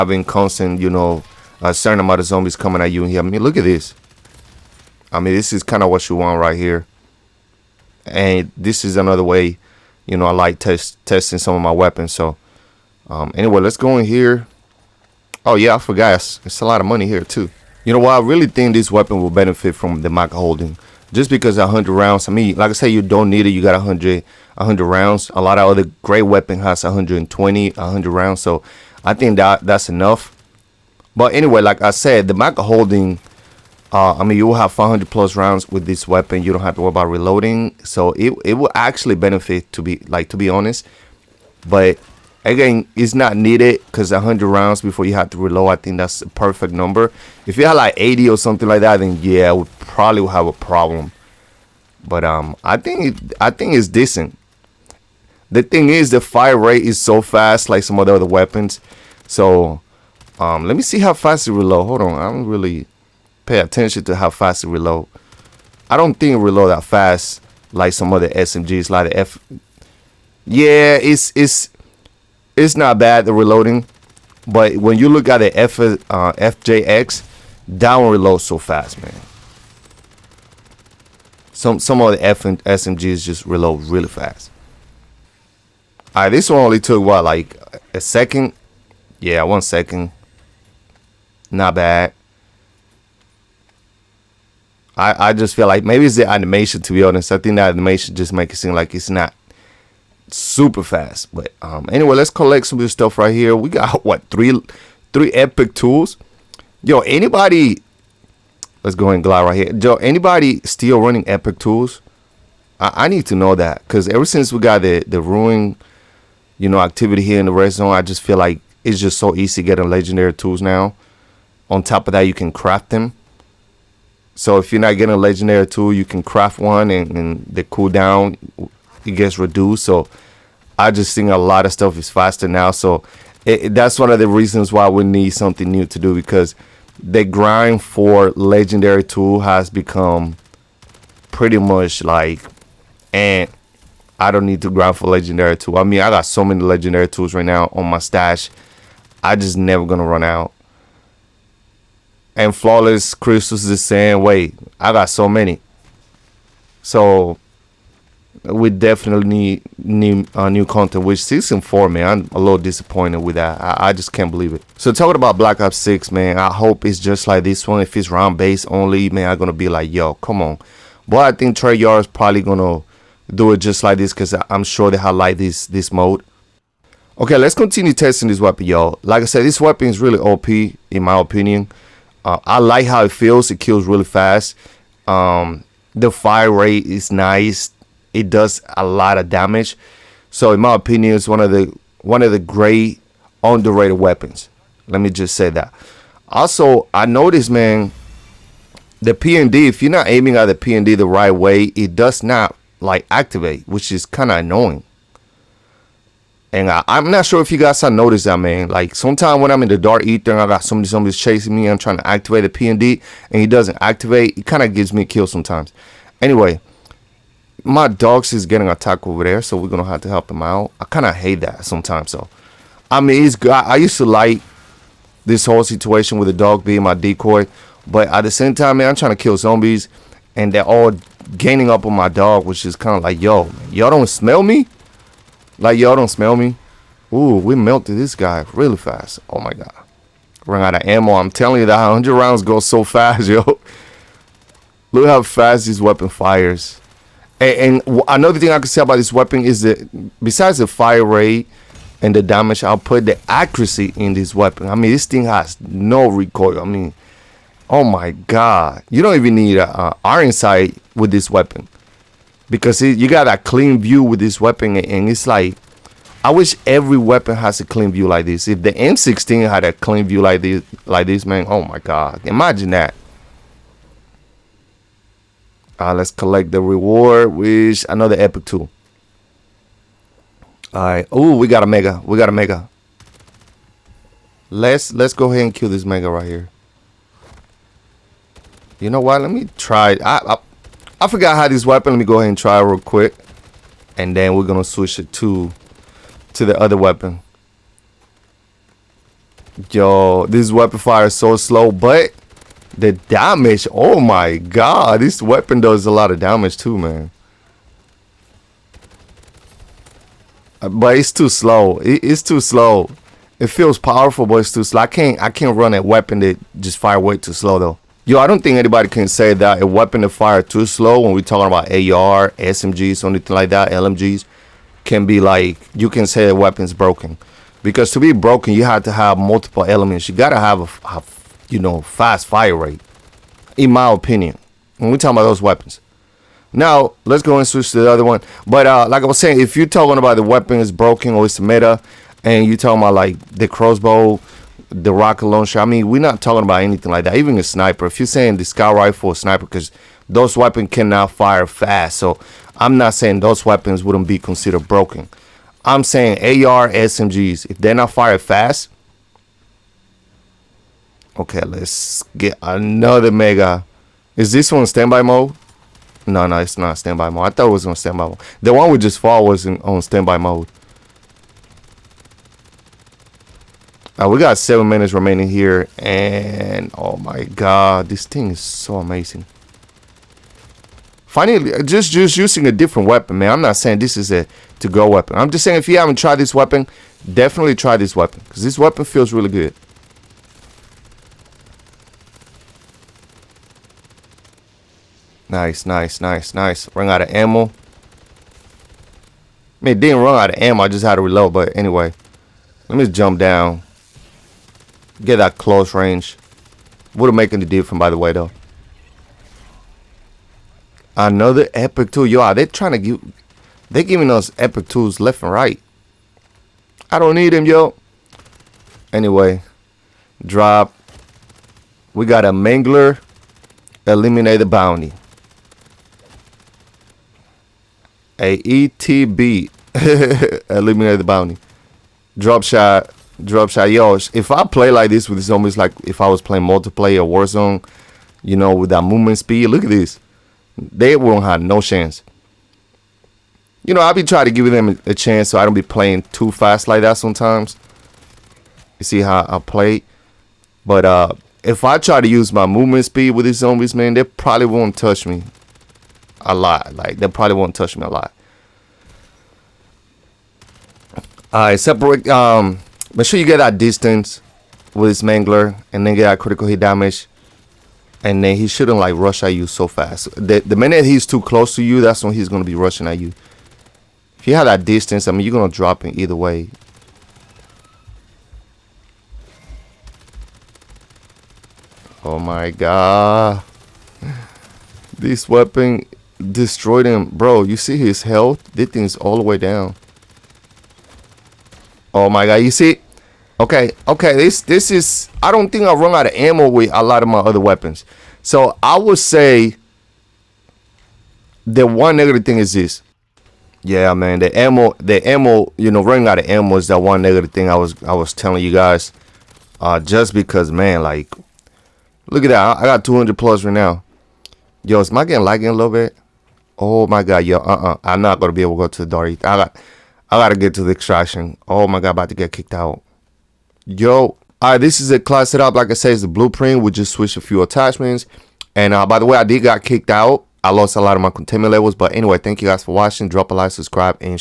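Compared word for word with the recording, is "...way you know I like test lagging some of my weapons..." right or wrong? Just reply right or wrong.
wrong.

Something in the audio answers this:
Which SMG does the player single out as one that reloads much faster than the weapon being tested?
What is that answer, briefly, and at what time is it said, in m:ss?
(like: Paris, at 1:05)
FJX, at 1:16.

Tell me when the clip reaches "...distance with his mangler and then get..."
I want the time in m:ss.
7:43.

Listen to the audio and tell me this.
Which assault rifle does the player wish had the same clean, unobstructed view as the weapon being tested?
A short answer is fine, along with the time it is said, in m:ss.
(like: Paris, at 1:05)
M16, at 4:28.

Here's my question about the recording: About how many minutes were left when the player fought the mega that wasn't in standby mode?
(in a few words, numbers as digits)
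7.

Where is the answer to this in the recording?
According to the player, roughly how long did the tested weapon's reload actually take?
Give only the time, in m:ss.
1:29.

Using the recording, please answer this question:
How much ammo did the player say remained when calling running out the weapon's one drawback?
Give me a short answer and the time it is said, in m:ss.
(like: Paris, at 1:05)
200 plus, at 8:32.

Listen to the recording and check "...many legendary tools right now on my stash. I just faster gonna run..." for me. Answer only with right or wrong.
wrong.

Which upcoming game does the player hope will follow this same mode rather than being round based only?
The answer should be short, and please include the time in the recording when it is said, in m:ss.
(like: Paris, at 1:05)
Black Ops Six, at 2:45.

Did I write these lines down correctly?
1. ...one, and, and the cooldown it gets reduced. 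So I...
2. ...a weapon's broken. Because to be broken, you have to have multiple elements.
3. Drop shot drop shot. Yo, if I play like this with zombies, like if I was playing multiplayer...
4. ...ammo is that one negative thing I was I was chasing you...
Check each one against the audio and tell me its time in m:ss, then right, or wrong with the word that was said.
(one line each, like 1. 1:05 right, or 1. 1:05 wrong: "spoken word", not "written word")
1. 2:06 right
2. 5:26 right
3. 7:12 right
4. 8:26 wrong: "telling", not "chasing".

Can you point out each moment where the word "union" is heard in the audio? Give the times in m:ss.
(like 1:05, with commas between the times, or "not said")
not said.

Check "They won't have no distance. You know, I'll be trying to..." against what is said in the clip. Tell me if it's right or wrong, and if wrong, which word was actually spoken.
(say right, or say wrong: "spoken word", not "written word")
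wrong: "chance", not "distance".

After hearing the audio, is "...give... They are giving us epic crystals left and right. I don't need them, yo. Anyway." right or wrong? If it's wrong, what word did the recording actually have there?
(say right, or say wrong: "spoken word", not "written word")
wrong: "tools", not "crystals".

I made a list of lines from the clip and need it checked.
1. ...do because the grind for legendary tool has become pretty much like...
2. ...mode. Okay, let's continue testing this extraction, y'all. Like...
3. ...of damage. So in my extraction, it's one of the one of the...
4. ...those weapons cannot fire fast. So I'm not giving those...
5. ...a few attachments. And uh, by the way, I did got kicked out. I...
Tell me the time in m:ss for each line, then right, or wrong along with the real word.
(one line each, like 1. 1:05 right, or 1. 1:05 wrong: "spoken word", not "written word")
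1. 2:15 right
2. 2:55 wrong: "weapon", not "extraction"
3. 3:09 wrong: "opinion", not "extraction"
4. 5:50 wrong: "saying", not "giving"
5. 8:47 right.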